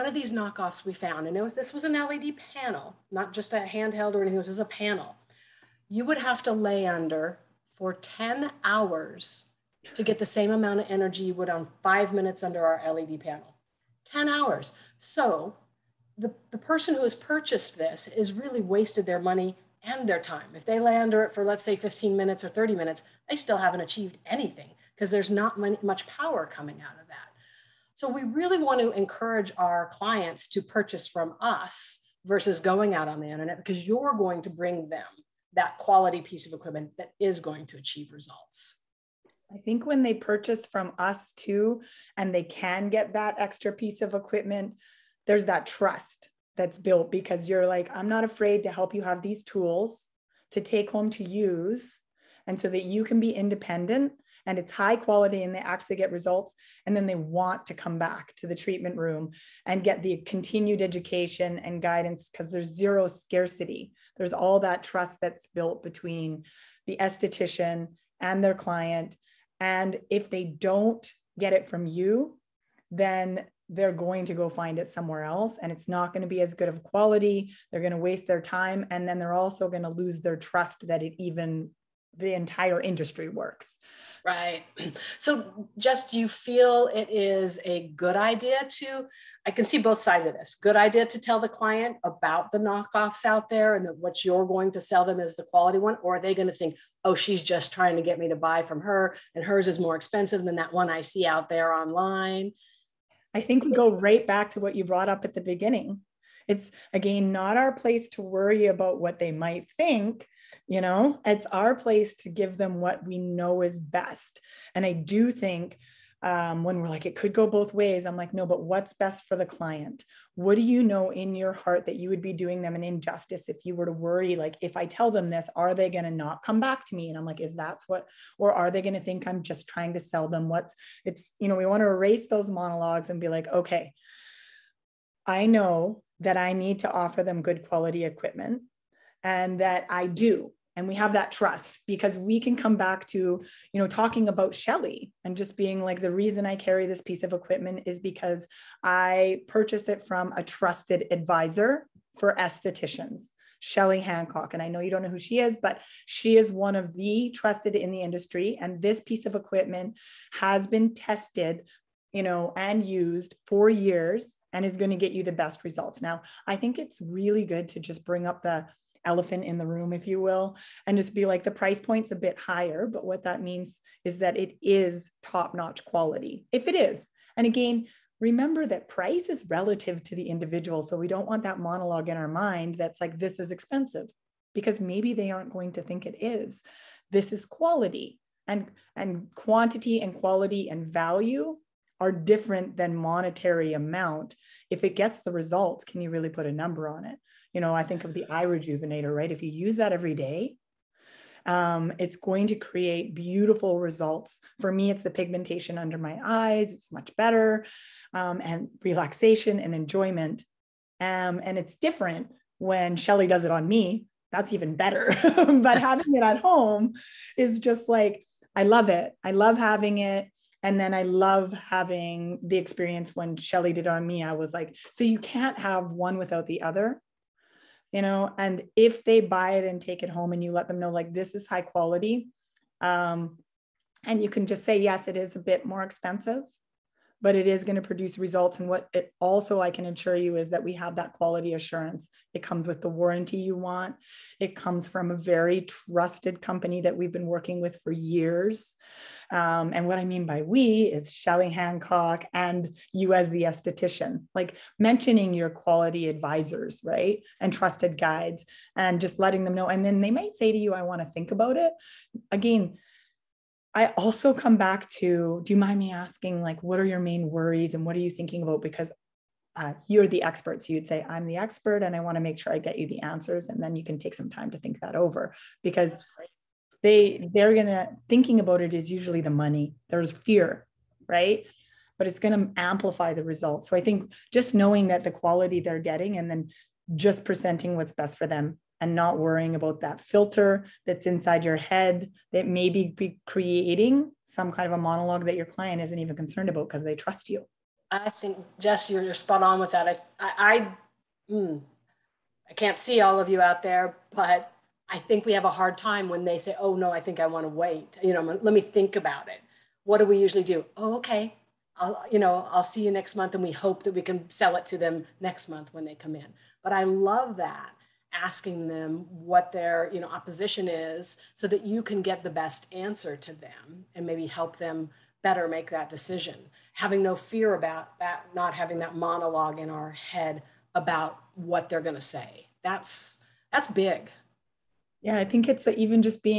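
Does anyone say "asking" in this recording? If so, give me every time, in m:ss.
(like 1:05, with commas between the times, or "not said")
4:25, 5:18.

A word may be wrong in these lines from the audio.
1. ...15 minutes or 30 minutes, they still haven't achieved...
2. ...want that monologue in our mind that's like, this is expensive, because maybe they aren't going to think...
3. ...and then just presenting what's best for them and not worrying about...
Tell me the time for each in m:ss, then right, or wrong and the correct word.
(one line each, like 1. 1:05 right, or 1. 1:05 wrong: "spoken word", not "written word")
1. 0:21 right
2. 3:01 right
3. 4:46 right.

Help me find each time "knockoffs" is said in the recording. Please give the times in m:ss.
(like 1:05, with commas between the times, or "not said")
0:00, 1:32.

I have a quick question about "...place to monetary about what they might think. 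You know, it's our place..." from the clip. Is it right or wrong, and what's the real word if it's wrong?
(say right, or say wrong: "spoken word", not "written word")
wrong: "worry", not "monetary".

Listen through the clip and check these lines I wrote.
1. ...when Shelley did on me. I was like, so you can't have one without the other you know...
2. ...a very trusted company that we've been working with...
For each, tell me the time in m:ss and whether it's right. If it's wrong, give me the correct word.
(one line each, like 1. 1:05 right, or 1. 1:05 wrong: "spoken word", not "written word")
1. 3:43 right
2. 4:05 right.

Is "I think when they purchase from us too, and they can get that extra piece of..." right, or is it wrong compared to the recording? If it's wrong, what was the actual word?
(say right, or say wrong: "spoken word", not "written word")
right.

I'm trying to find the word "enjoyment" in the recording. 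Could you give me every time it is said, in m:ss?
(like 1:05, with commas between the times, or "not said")
3:29.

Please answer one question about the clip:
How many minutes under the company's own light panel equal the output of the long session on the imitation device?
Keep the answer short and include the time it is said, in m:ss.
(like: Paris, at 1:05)
5 minutes, at 0:11.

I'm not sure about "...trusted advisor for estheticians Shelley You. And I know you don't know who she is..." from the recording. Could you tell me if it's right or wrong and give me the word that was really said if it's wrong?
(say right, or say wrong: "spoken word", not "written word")
wrong: "Hancock", not "You".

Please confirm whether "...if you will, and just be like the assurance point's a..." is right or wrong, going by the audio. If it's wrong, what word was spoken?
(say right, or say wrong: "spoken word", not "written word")
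wrong: "price", not "assurance".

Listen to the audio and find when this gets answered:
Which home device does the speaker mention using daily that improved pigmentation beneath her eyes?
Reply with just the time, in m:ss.
3:18.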